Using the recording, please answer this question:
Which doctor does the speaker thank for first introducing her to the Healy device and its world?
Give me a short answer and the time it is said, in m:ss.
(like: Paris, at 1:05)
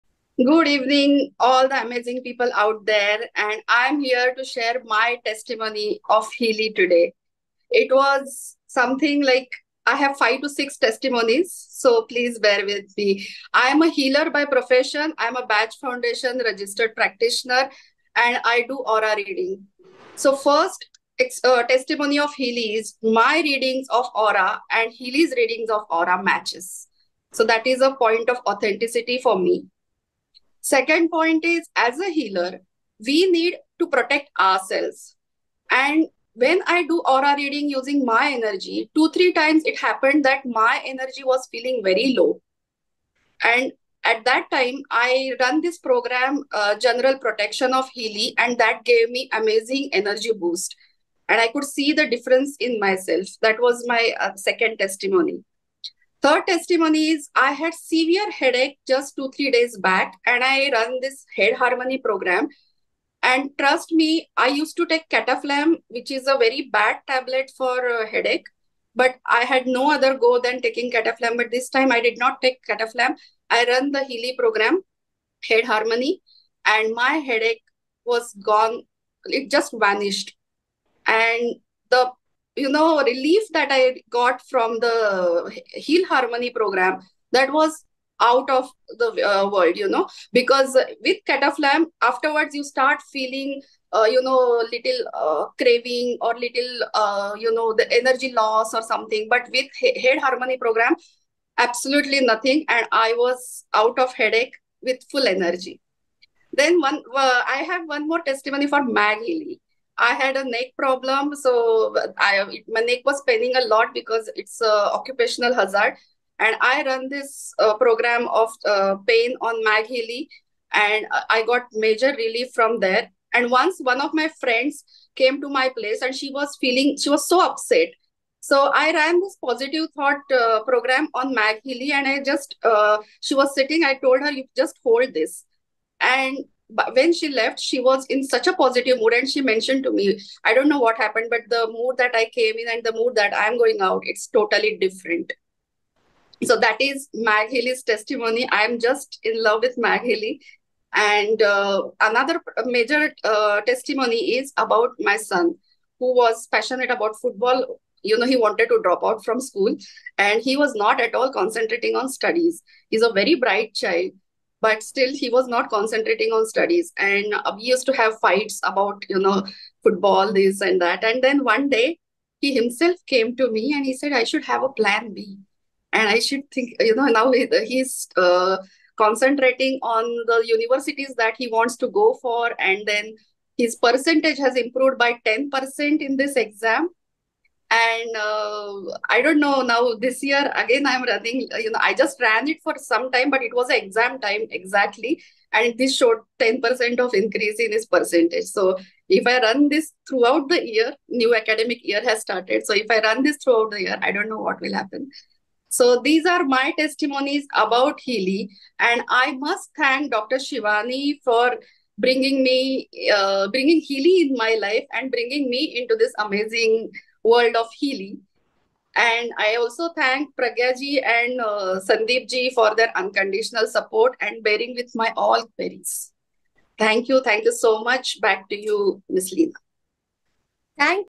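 Dr Shivani, at 3:30.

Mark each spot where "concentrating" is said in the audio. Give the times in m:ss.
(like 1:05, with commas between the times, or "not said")
2:41, 2:45, 2:59.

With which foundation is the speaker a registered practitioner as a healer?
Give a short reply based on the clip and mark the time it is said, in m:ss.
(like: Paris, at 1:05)
Bach Foundation, at 0:15.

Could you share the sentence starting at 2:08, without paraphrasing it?
So I ran this positive thought uh, program on Mag Healy, and I just uh, she was sitting.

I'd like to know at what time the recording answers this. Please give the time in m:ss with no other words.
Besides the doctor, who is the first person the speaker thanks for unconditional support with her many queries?
3:40.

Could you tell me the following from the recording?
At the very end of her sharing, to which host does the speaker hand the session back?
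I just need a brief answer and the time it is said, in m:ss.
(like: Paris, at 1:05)
Ms. Leena, at 3:49.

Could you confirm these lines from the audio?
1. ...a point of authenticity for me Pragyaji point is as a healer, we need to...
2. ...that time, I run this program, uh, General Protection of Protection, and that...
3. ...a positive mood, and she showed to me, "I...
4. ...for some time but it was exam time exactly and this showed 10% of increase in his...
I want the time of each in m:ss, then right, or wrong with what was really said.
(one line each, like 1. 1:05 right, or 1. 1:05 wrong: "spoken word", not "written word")
1. 0:27 wrong: "Second", not "Pragyaji"
2. 0:44 wrong: "Healy", not "Protection"
3. 2:18 wrong: "mentioned", not "showed"
4. 3:12 right.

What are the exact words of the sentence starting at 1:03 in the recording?
And trust me, I used to take cataflam, which is a very bad tablet for uh, headache.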